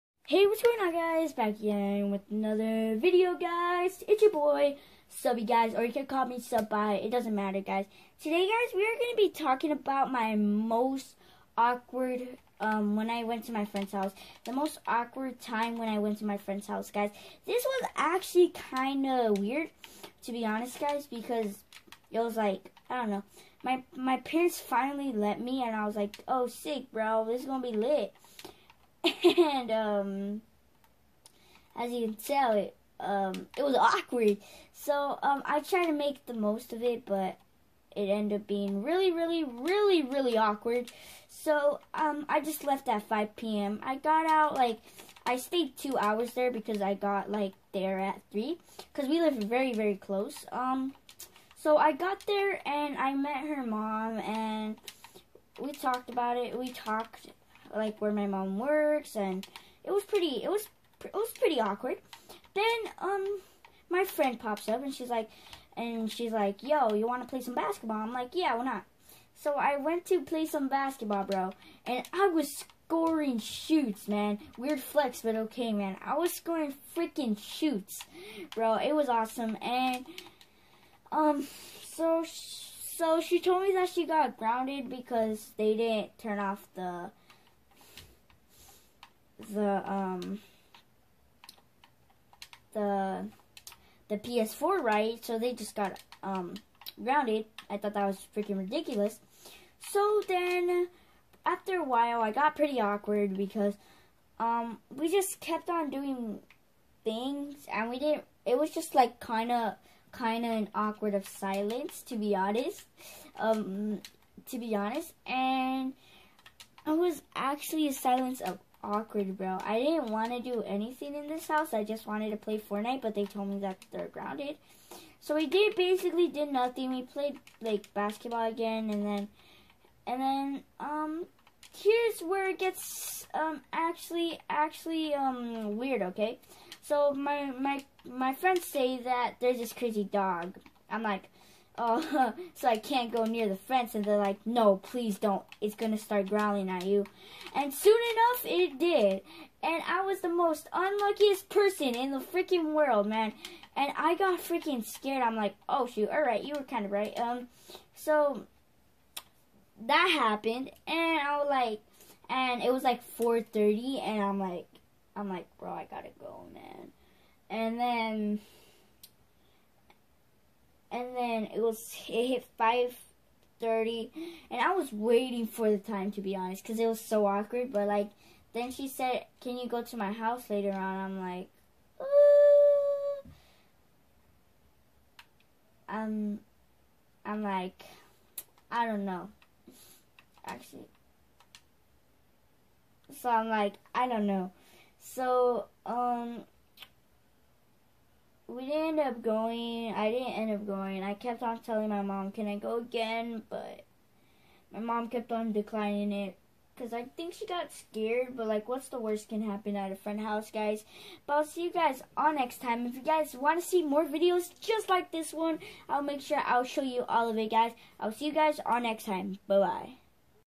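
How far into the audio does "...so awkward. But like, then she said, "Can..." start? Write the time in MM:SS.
02:56.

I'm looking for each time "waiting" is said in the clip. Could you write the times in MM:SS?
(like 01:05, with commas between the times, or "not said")
02:54.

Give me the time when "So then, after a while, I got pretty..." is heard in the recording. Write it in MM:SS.
01:39.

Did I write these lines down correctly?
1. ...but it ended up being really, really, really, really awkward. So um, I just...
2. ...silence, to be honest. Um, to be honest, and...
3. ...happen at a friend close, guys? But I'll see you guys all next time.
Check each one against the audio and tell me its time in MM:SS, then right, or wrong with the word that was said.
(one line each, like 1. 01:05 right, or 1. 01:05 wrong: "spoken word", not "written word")
1. 00:37 right
2. 01:51 right
3. 03:29 wrong: "house", not "close".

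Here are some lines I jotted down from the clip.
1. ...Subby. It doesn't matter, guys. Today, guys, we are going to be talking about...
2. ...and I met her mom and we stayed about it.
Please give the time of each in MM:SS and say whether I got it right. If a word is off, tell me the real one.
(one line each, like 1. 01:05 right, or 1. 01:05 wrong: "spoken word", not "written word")
1. 00:06 right
2. 00:52 wrong: "talked", not "stayed".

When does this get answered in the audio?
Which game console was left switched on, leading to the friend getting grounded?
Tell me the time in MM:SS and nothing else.
01:34.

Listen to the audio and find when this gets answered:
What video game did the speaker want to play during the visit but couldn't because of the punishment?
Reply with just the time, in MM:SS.
02:02.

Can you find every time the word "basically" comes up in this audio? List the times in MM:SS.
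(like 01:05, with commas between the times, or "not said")
02:05.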